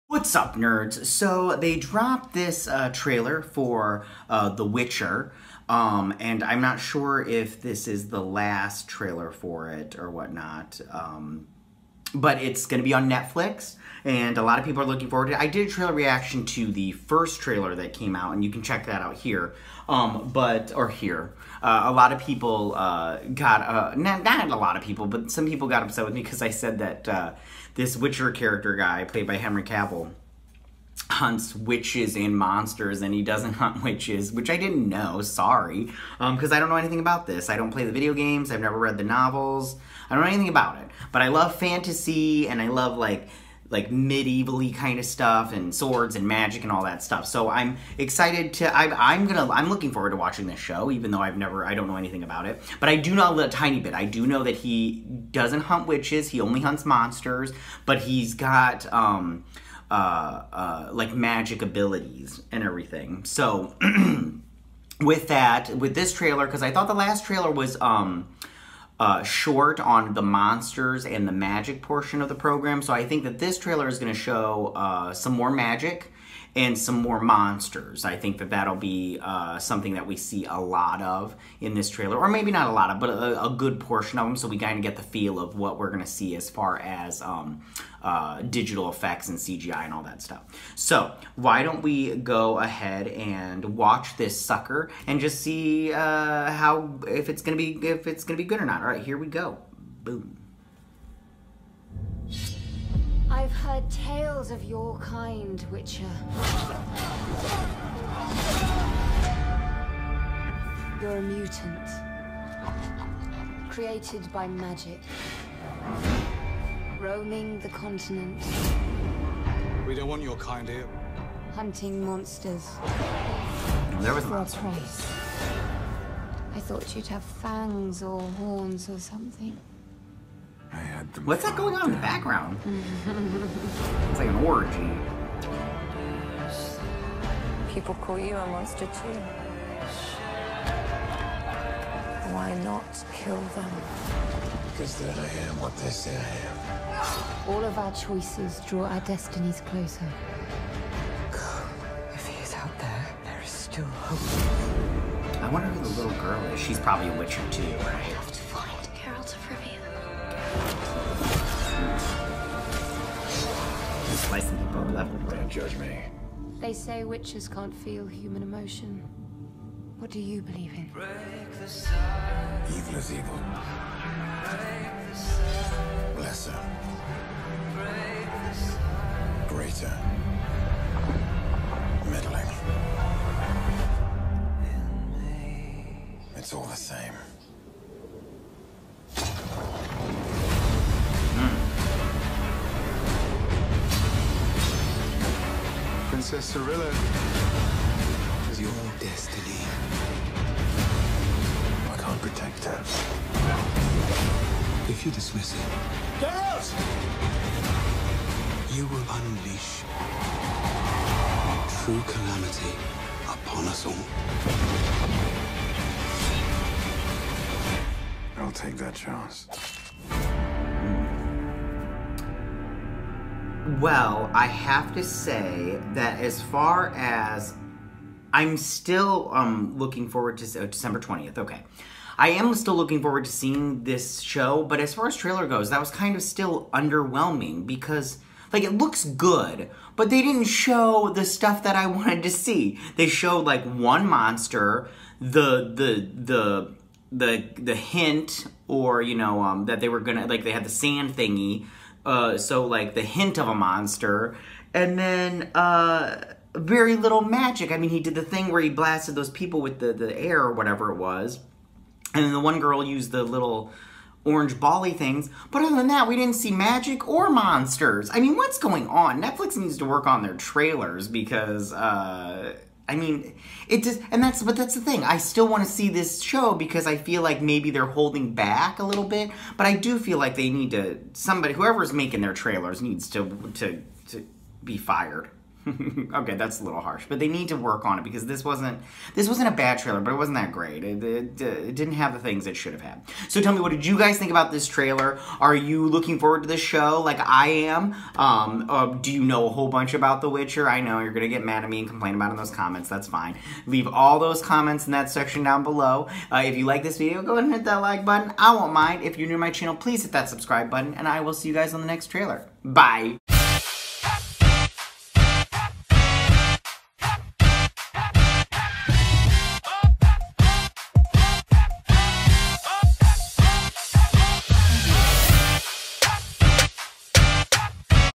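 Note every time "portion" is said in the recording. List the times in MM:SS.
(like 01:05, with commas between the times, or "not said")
01:11, 01:23.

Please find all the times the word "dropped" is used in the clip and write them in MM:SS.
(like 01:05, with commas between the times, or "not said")
00:01.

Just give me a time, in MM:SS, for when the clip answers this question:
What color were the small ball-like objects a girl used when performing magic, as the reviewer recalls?
04:24.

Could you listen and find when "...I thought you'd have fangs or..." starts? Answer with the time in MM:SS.
02:06.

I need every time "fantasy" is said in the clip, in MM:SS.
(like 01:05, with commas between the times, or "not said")
00:41.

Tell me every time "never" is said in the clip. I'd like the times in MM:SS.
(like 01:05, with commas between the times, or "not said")
00:38, 00:51.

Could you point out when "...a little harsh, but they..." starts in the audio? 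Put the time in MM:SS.
04:46.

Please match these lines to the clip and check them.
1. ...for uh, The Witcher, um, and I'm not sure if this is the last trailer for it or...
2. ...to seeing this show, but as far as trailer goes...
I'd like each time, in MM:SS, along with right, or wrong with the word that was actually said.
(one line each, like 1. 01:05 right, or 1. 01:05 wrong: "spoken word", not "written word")
1. 00:03 right
2. 03:53 right.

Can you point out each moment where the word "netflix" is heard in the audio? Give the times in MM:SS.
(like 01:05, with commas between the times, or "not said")
00:13, 04:29.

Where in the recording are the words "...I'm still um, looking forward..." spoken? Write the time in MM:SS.
03:48.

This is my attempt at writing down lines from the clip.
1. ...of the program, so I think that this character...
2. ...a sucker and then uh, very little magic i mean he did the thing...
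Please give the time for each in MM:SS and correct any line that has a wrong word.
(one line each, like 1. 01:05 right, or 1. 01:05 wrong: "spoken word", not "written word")
1. 01:12 wrong: "trailer", not "character"
2. 04:13 wrong: "monster", not "sucker".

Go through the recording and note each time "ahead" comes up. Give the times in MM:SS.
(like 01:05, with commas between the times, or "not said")
01:32, 05:07.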